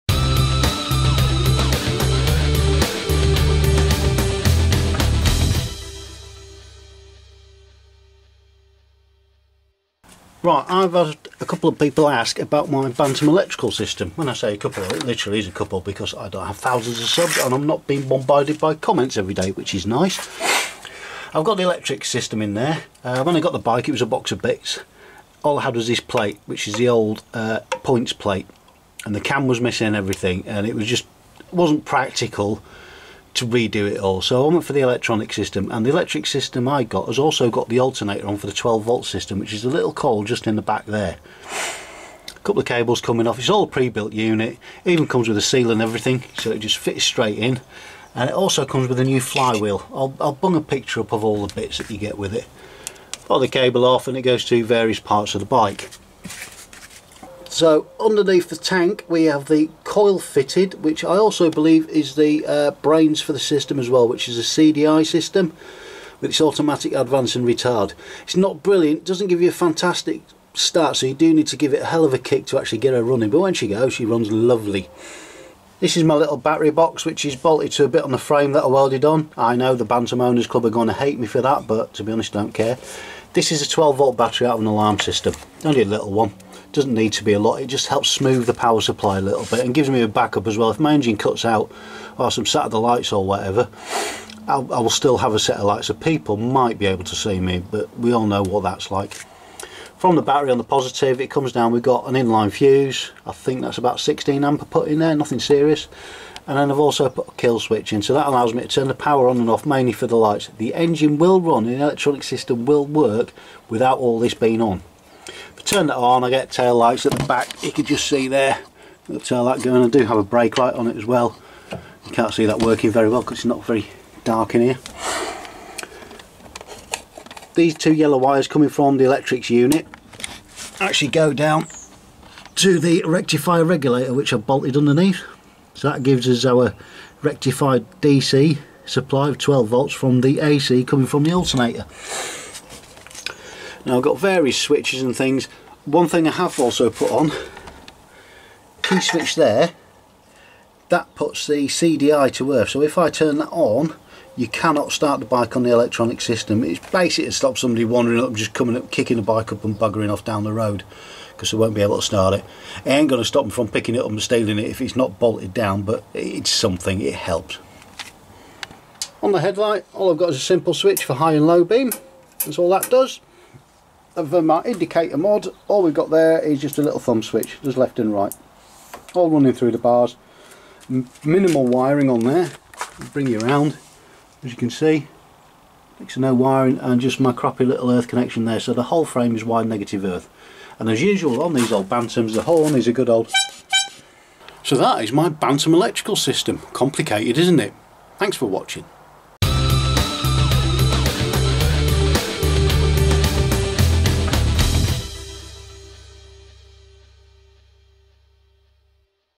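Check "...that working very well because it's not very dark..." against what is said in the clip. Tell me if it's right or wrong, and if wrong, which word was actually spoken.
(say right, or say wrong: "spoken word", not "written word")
right.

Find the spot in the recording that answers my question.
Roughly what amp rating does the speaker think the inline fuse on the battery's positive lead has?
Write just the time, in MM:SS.
01:43.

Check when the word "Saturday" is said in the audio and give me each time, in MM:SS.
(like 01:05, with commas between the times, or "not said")
01:32.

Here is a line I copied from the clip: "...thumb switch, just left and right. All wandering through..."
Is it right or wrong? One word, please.
wrong.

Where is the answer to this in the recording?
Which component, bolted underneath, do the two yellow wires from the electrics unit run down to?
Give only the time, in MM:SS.
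02:13.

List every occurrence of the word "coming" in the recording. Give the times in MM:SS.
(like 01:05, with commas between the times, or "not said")
00:43, 02:08, 02:20, 02:38.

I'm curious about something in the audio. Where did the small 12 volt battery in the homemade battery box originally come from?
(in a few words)
An alarm system.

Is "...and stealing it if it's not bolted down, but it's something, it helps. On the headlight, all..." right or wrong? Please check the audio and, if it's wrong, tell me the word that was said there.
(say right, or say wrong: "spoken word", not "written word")
right.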